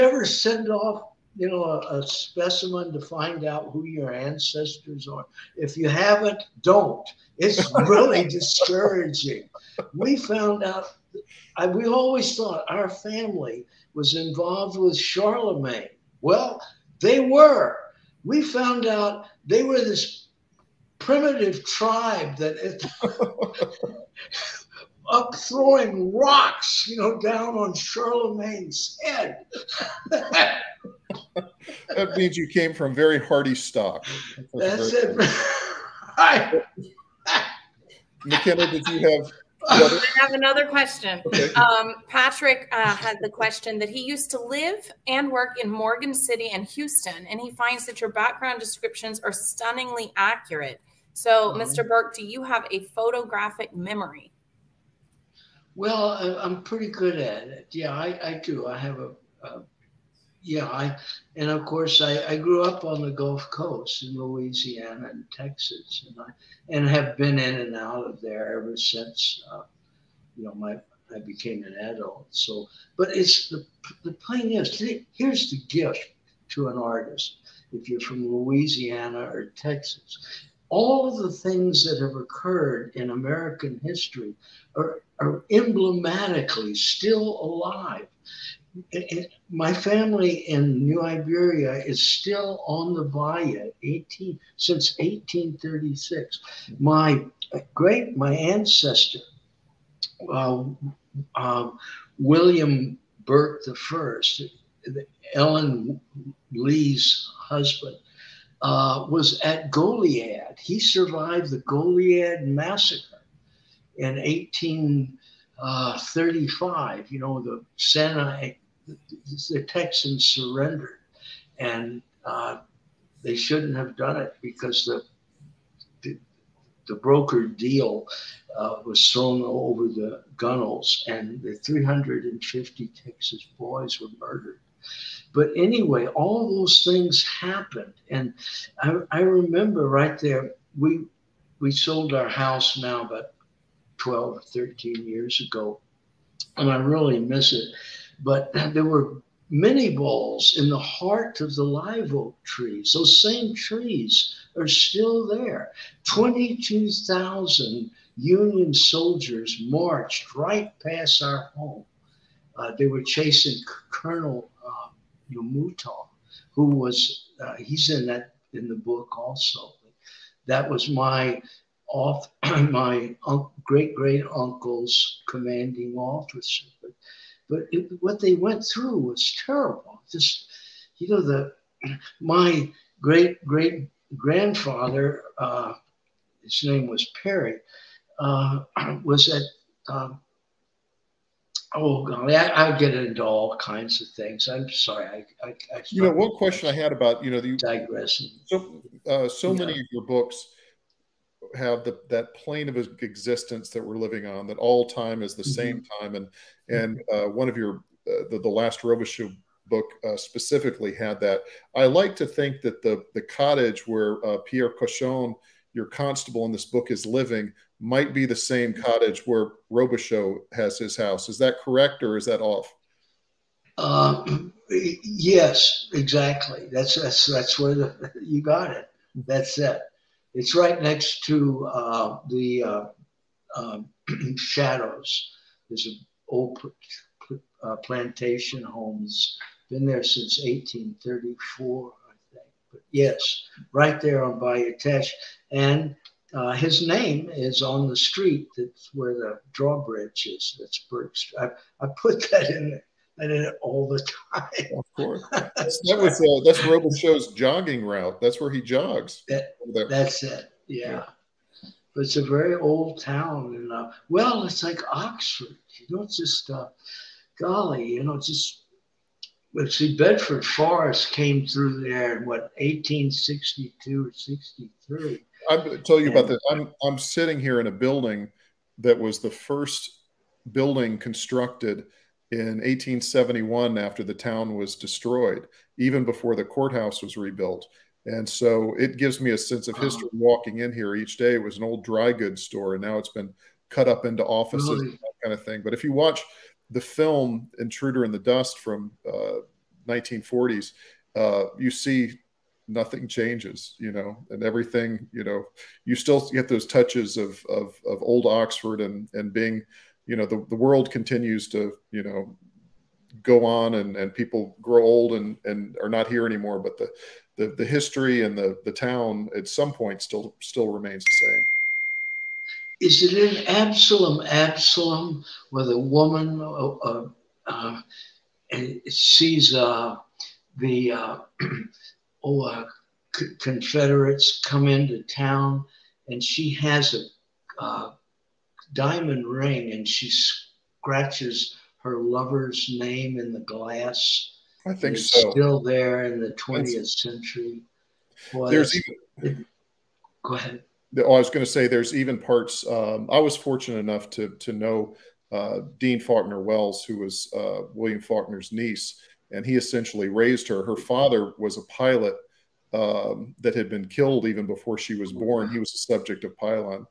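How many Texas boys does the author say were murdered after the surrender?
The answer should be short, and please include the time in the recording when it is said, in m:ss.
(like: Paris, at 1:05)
350, at 2:11.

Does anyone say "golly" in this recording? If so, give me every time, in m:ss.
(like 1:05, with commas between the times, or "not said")
3:12, 4:27.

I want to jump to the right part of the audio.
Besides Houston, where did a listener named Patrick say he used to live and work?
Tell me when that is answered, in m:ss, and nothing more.
0:45.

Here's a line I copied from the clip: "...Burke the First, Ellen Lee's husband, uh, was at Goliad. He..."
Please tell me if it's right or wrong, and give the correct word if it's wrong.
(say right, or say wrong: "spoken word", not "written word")
right.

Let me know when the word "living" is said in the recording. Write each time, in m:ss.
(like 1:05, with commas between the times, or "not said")
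3:23, 3:37.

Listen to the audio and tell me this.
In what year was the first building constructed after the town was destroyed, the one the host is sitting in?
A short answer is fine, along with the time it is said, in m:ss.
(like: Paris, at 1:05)
1871, at 4:42.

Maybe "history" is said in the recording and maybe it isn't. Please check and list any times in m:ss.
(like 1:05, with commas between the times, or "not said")
1:23, 4:49, 5:17.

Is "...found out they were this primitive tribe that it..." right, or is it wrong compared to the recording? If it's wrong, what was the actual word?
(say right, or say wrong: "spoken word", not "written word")
right.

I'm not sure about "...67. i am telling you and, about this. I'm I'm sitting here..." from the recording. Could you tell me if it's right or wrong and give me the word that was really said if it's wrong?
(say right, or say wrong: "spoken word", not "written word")
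wrong: "63", not "67".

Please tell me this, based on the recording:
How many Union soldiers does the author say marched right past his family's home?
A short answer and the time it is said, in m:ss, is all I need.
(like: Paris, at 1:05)
22,000, at 2:36.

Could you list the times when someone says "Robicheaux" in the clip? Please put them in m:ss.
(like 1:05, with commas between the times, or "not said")
3:28, 3:39.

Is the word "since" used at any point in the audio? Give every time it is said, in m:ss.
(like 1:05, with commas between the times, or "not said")
1:08, 1:34, 4:00.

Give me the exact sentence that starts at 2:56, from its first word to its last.
But but it, what they went through was terrible.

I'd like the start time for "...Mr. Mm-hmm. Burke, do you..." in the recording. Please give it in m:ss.
0:51.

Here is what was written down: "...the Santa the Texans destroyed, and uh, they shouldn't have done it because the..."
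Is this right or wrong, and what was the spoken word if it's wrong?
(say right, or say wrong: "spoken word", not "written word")
wrong: "surrendered", not "destroyed".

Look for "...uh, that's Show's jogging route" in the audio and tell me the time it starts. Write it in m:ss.
4:16.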